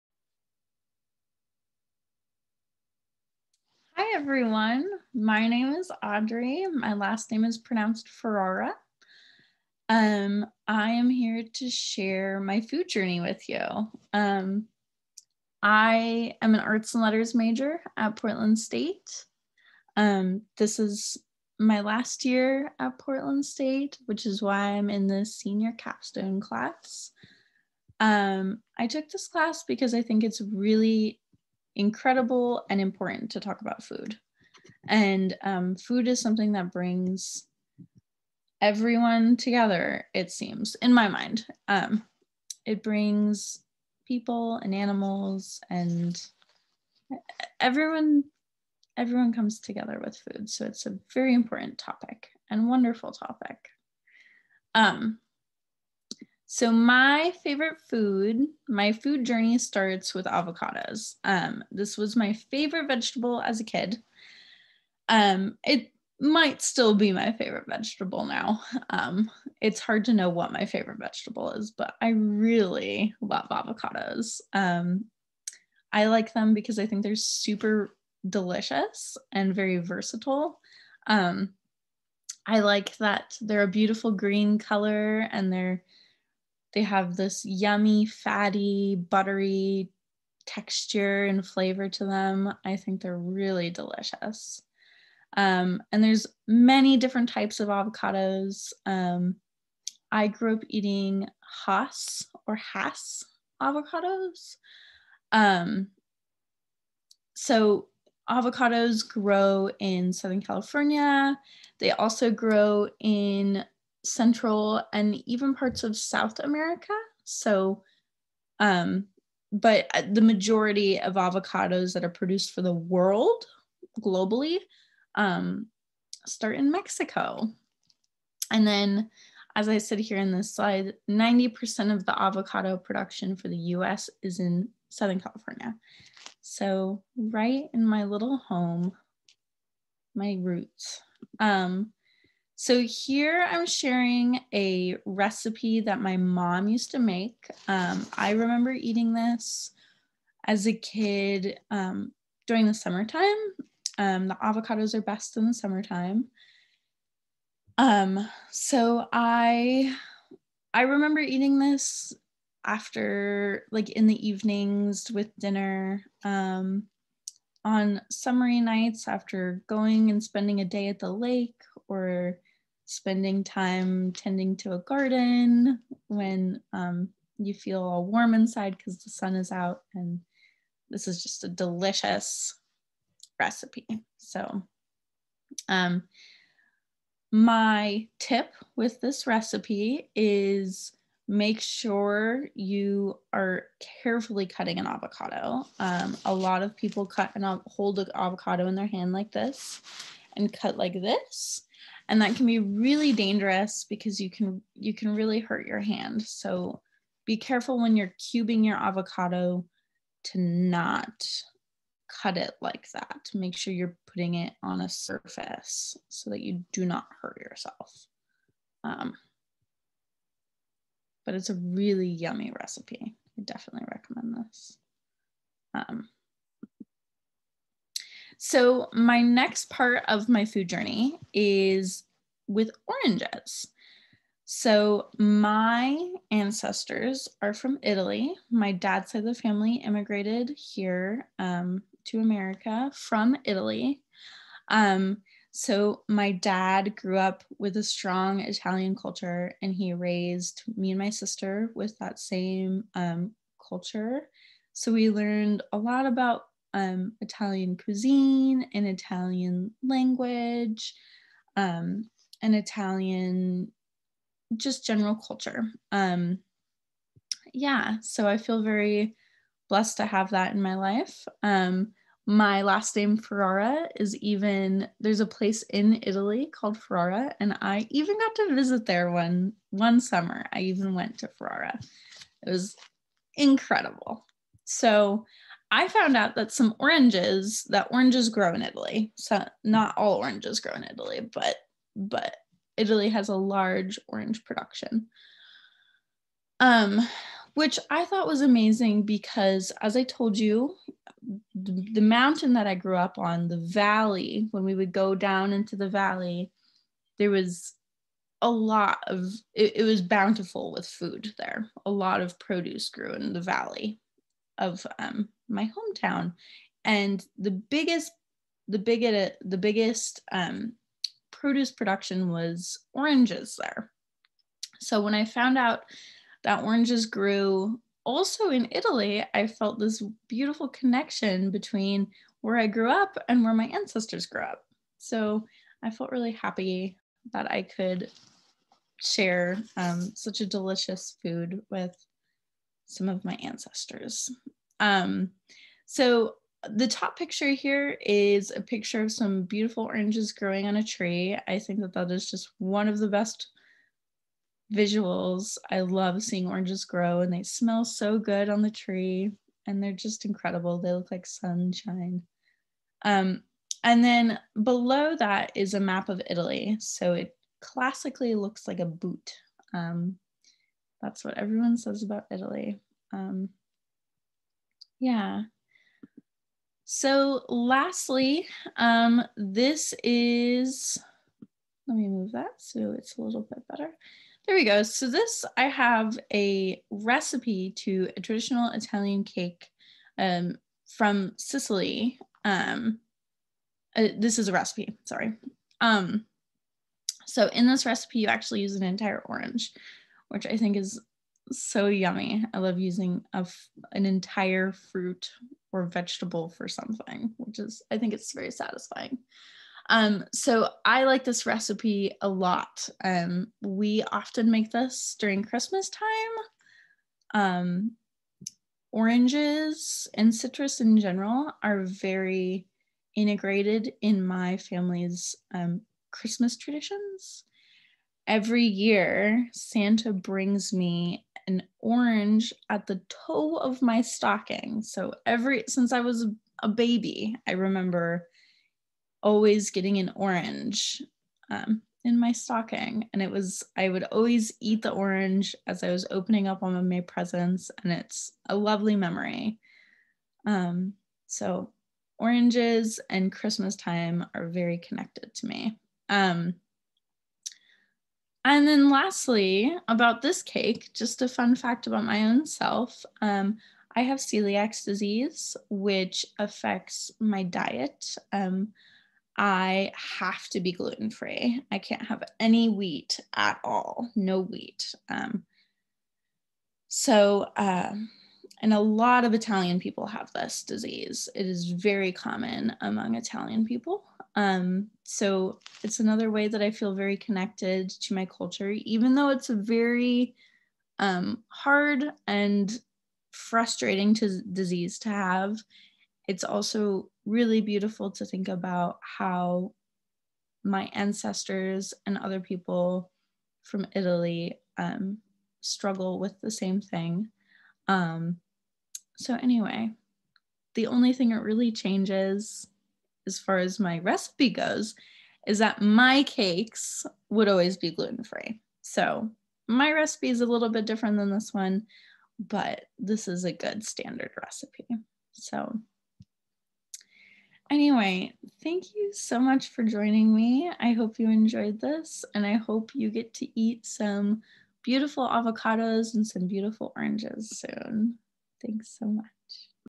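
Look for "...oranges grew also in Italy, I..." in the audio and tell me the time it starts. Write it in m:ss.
5:26.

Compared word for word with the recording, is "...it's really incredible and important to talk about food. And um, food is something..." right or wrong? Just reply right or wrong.
right.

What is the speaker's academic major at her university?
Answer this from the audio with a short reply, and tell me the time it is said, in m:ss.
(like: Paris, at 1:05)
Arts and letters, at 0:16.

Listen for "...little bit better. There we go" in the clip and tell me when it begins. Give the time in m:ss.
6:23.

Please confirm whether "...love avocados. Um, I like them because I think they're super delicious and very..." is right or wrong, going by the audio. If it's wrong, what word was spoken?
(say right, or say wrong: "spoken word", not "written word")
right.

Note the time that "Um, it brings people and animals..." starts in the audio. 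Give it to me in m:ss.
0:41.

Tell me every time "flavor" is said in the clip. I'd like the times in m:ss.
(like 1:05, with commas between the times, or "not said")
1:31.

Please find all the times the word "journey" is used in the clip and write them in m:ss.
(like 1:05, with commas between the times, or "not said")
0:12, 0:59, 3:50.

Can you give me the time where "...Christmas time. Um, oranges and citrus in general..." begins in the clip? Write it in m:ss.
6:55.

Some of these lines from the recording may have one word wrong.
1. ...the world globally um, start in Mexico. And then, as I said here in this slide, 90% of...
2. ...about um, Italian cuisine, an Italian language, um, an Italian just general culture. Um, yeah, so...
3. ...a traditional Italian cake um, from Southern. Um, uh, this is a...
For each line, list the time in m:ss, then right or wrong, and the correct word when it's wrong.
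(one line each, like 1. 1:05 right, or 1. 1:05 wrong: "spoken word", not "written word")
1. 2:02 right
2. 4:16 right
3. 6:28 wrong: "Sicily", not "Southern".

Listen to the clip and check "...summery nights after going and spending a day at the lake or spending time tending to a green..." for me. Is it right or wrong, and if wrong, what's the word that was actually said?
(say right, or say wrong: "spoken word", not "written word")
wrong: "garden", not "green".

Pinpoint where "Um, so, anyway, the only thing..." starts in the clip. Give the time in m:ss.
8:27.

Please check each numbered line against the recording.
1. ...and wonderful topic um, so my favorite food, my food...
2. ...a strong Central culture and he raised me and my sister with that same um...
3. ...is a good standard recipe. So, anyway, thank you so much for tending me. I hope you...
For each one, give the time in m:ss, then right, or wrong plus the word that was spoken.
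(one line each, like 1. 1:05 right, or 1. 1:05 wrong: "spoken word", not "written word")
1. 0:52 right
2. 4:07 wrong: "Italian", not "Central"
3. 8:43 wrong: "joining", not "tending".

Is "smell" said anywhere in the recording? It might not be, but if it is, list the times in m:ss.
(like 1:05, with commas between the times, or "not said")
5:57.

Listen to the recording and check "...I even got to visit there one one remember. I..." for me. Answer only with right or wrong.
wrong.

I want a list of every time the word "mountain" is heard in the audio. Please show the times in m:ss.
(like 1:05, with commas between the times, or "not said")
5:02.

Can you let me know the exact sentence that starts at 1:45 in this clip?
Um, so avocados grow in Southern California.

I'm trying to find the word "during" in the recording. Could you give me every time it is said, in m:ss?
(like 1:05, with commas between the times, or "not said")
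2:32, 6:55.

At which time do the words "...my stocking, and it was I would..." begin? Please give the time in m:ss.
7:22.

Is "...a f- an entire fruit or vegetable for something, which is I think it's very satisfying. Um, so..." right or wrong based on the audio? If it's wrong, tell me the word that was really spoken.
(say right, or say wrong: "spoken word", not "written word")
right.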